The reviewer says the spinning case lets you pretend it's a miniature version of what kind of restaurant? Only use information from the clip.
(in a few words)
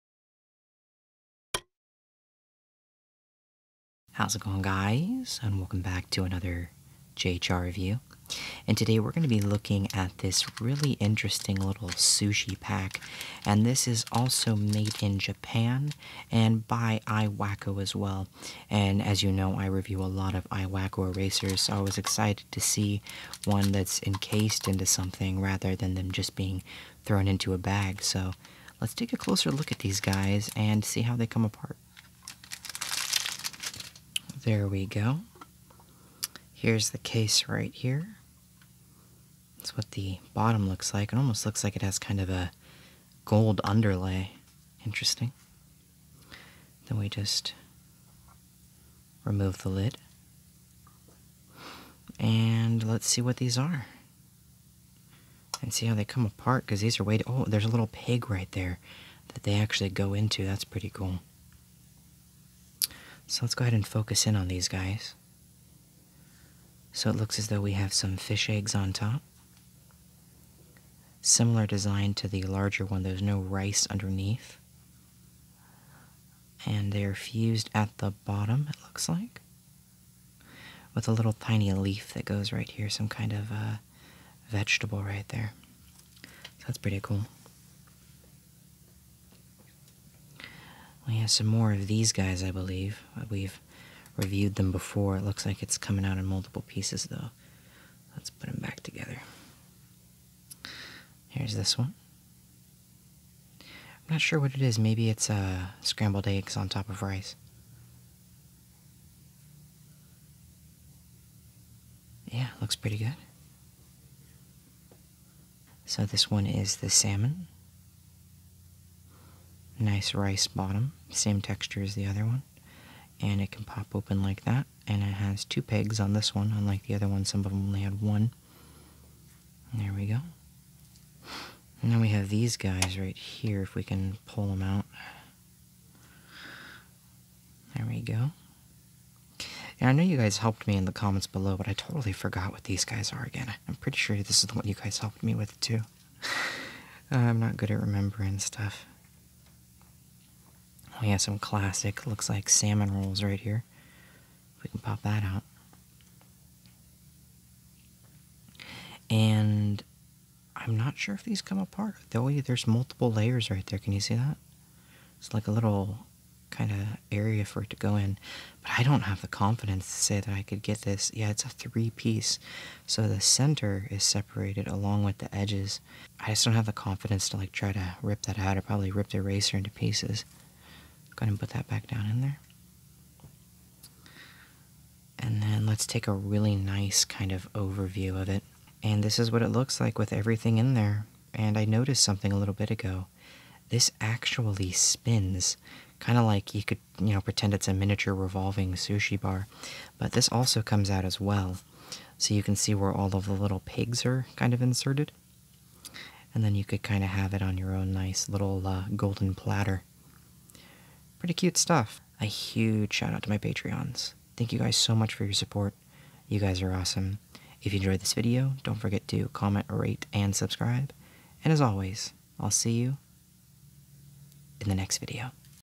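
Revolving sushi bar.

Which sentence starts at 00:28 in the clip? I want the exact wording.
So let's take a closer look at these guys and see how they come apart.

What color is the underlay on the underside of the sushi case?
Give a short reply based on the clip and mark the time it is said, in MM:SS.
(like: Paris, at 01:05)
Gold, at 00:43.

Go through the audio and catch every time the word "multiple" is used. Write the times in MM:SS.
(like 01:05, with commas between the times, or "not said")
01:36, 02:42.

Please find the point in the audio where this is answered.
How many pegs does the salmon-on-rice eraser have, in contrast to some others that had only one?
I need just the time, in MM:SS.
02:05.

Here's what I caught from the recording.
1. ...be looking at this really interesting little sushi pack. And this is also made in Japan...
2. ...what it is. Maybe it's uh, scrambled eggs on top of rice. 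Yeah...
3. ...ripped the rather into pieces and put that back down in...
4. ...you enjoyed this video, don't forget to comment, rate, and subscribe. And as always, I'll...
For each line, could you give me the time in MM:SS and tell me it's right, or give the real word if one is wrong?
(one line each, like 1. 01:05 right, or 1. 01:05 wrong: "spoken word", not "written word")
1. 00:09 right
2. 01:44 right
3. 02:58 wrong: "eraser", not "rather"
4. 03:37 right.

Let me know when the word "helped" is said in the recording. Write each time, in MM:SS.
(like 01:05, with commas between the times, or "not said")
02:20, 02:24.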